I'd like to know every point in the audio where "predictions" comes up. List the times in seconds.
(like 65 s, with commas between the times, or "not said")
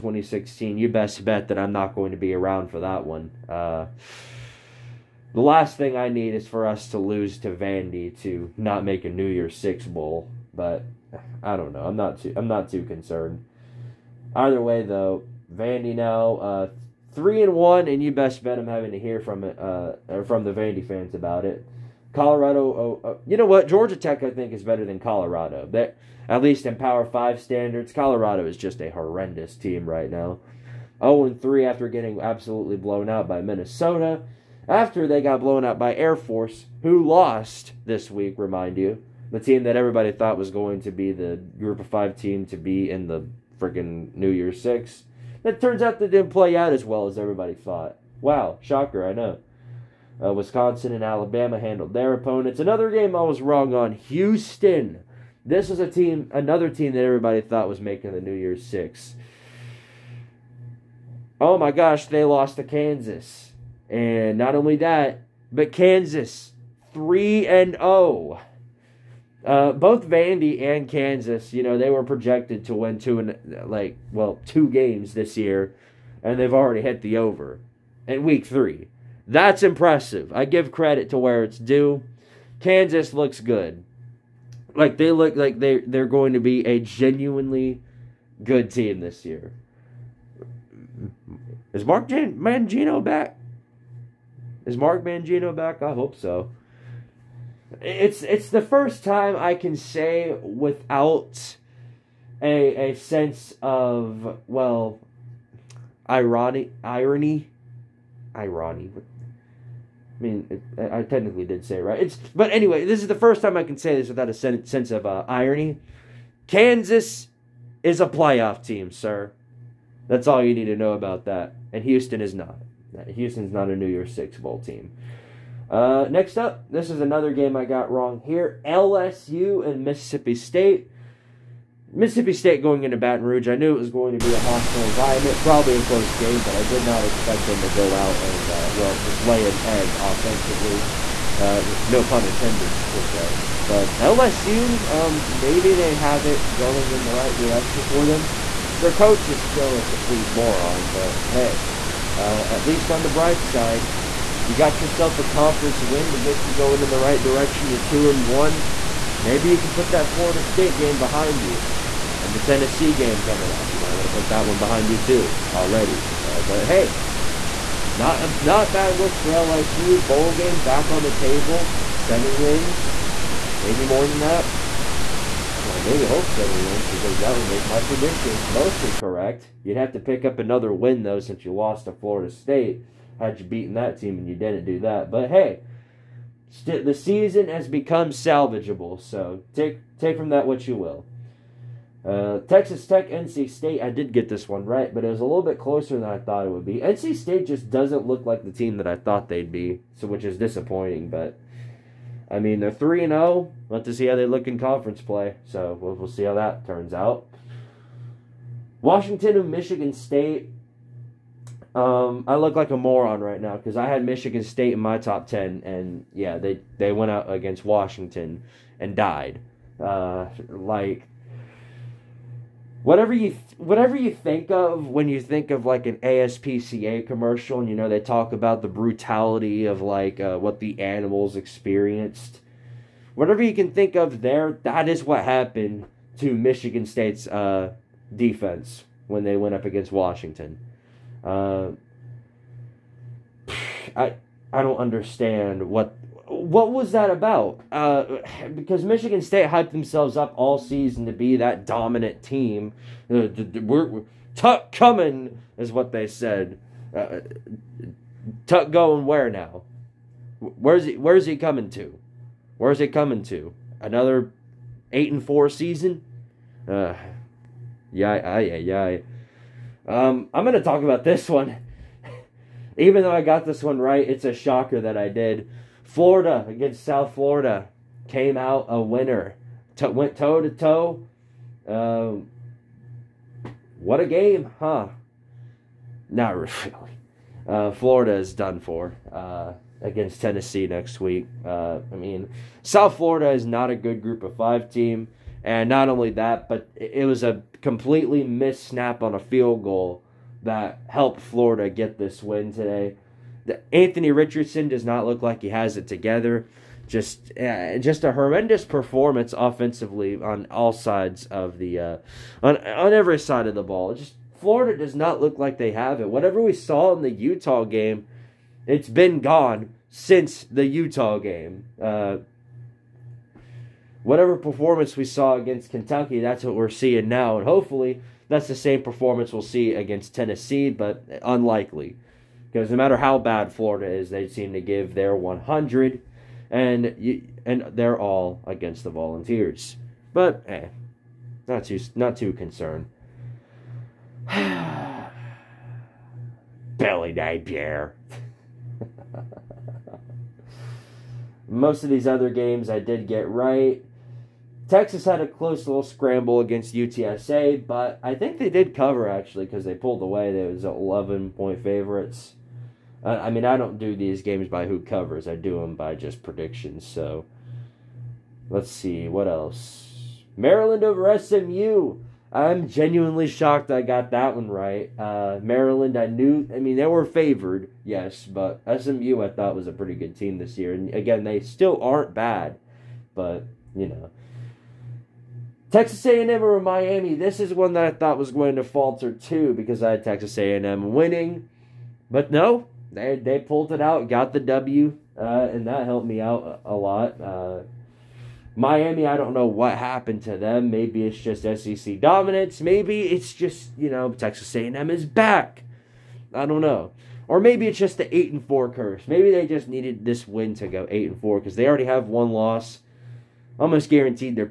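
177 s, 366 s.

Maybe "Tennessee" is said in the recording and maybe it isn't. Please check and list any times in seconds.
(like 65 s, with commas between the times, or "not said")
162 s, 290 s, 330 s.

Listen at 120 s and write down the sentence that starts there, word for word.
That's all you need to know about that.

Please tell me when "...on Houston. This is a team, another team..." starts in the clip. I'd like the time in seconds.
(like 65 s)
53 s.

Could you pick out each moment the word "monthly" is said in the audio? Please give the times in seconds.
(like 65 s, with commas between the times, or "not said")
not said.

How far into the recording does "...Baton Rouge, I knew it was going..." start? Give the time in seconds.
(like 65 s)
132 s.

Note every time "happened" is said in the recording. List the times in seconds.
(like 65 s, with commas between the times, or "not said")
235 s, 399 s.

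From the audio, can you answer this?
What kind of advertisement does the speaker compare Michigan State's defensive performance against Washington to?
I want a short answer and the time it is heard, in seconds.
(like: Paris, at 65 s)
ASPCA commercial, at 225 s.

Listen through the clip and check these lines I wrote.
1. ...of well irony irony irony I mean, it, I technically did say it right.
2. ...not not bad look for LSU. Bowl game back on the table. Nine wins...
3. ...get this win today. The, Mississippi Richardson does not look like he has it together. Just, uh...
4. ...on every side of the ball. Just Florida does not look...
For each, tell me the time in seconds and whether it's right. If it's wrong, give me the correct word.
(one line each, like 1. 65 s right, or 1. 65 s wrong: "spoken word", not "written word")
1. 103 s right
2. 167 s wrong: "Seven", not "Nine"
3. 301 s wrong: "Anthony", not "Mississippi"
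4. 312 s right.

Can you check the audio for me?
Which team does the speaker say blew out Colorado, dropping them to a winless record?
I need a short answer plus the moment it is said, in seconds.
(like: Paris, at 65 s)
Minnesota, at 33 s.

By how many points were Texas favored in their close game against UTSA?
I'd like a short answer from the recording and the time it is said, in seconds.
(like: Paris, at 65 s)
11, at 360 s.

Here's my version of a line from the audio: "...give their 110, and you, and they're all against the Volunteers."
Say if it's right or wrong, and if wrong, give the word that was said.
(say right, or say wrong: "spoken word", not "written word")
wrong: "100", not "110".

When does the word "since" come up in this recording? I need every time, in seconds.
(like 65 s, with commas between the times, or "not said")
181 s, 319 s.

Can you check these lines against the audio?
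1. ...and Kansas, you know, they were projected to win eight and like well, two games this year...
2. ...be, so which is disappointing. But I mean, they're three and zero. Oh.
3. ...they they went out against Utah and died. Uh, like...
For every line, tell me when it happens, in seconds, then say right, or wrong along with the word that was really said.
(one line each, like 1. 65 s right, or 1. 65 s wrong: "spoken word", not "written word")
1. 70 s wrong: "two", not "eight"
2. 199 s right
3. 216 s wrong: "Washington", not "Utah".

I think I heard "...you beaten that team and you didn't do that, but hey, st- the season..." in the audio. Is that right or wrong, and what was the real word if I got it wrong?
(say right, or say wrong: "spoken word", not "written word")
right.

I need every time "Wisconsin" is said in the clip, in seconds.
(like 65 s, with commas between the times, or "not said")
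50 s.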